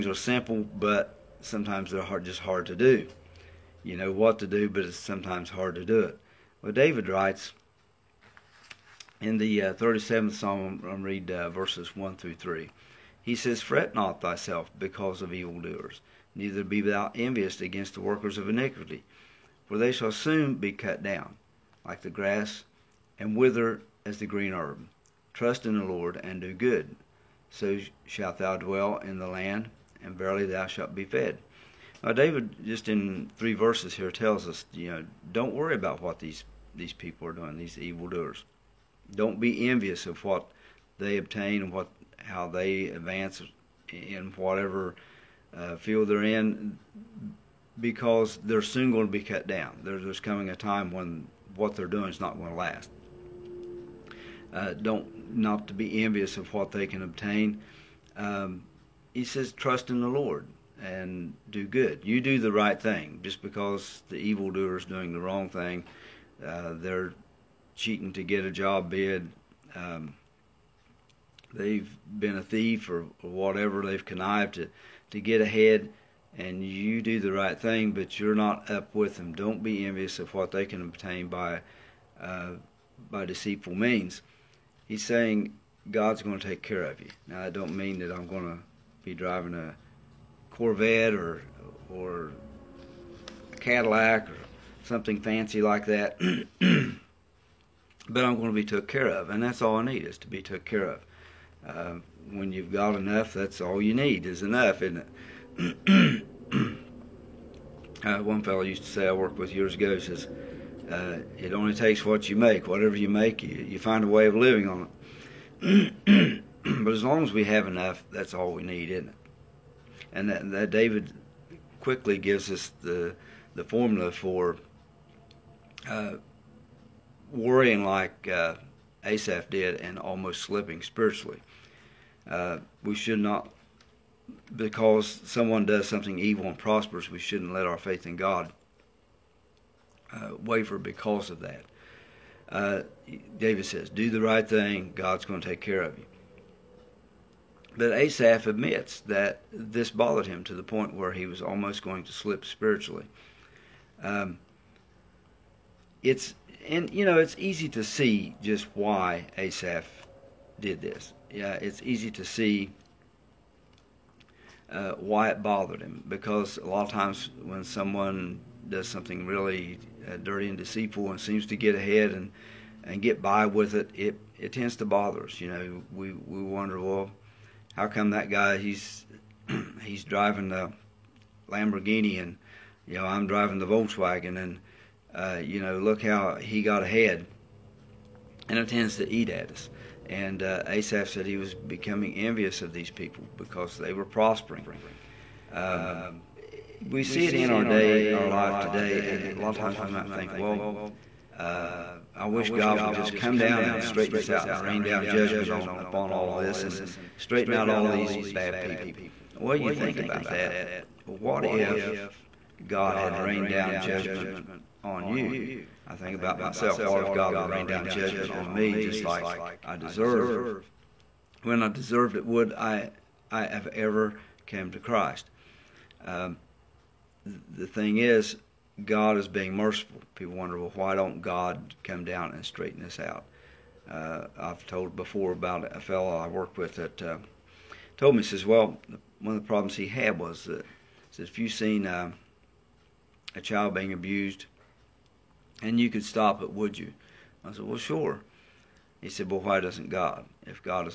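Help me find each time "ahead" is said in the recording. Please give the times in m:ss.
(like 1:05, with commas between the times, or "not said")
1:15, 2:51, 3:06.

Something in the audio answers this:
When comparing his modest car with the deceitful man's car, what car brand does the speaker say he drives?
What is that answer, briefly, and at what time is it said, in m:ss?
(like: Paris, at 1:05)
Volkswagen, at 3:03.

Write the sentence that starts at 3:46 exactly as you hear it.
Um, the thing is, God is being merciful.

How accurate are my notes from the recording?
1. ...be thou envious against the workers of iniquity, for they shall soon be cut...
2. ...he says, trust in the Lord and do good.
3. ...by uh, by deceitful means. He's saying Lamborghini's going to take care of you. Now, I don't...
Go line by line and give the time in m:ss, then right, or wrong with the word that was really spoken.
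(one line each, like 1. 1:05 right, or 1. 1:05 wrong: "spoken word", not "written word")
1. 0:16 right
2. 0:59 right
3. 1:21 wrong: "God", not "Lamborghini".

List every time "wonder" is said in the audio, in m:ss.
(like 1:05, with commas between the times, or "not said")
2:56, 3:50.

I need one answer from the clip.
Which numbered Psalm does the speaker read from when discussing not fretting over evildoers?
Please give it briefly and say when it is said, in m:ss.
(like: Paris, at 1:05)
37th Psalm, at 0:09.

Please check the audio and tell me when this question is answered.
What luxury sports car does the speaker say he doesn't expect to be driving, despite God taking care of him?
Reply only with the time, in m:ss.
1:30.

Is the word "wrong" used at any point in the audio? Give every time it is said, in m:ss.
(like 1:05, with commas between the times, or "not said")
1:05.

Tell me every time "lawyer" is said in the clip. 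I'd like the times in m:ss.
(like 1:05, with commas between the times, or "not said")
not said.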